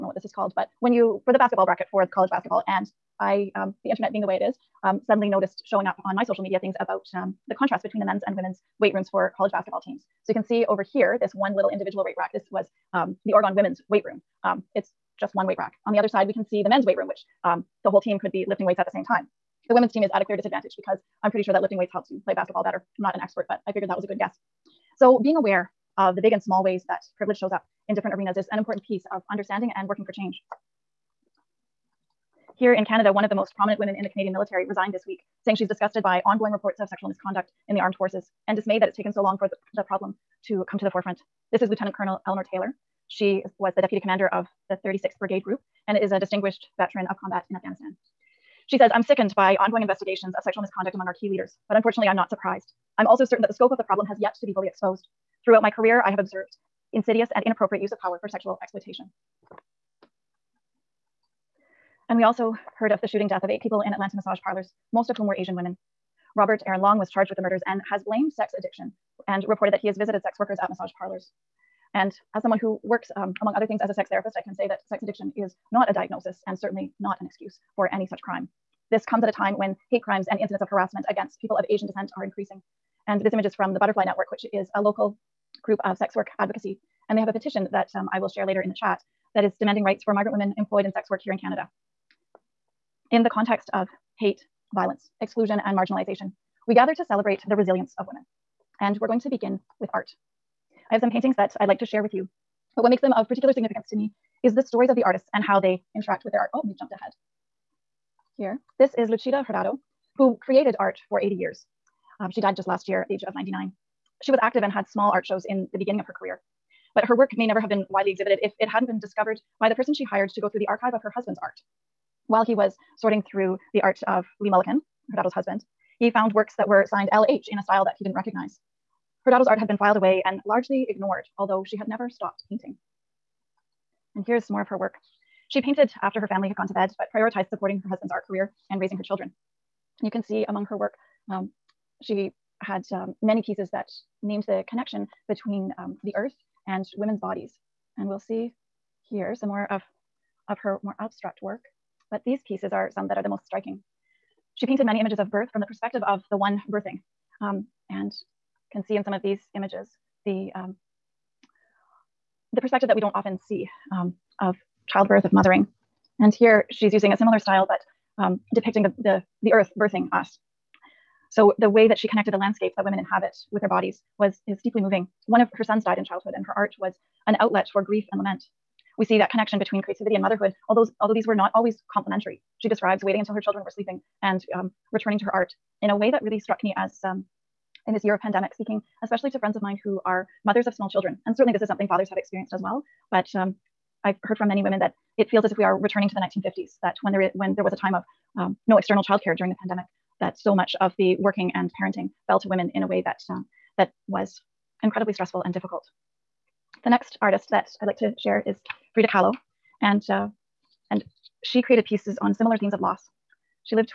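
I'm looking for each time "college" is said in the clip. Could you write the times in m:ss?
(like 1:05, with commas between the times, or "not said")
0:02, 0:09.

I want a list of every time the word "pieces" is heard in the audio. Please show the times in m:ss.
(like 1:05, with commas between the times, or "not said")
0:28, 2:23, 2:32, 3:31.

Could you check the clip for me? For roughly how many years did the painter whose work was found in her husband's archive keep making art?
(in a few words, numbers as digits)
80.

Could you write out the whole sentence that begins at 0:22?
I'm not an expert, but I figured that was a good guess.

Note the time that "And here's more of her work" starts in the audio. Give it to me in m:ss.
2:14.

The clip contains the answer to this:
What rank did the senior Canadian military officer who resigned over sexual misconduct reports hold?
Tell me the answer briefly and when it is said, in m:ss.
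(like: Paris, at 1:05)
Lieutenant Colonel, at 0:41.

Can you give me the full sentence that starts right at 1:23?
And this image is from the Butterfly Network, which is a local group of sex work advocacy.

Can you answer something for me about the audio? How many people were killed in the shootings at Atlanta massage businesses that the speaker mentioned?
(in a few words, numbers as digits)
8.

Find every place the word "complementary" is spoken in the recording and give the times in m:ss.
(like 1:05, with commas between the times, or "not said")
3:01.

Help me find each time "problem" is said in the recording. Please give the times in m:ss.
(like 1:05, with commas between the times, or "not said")
0:39, 0:53.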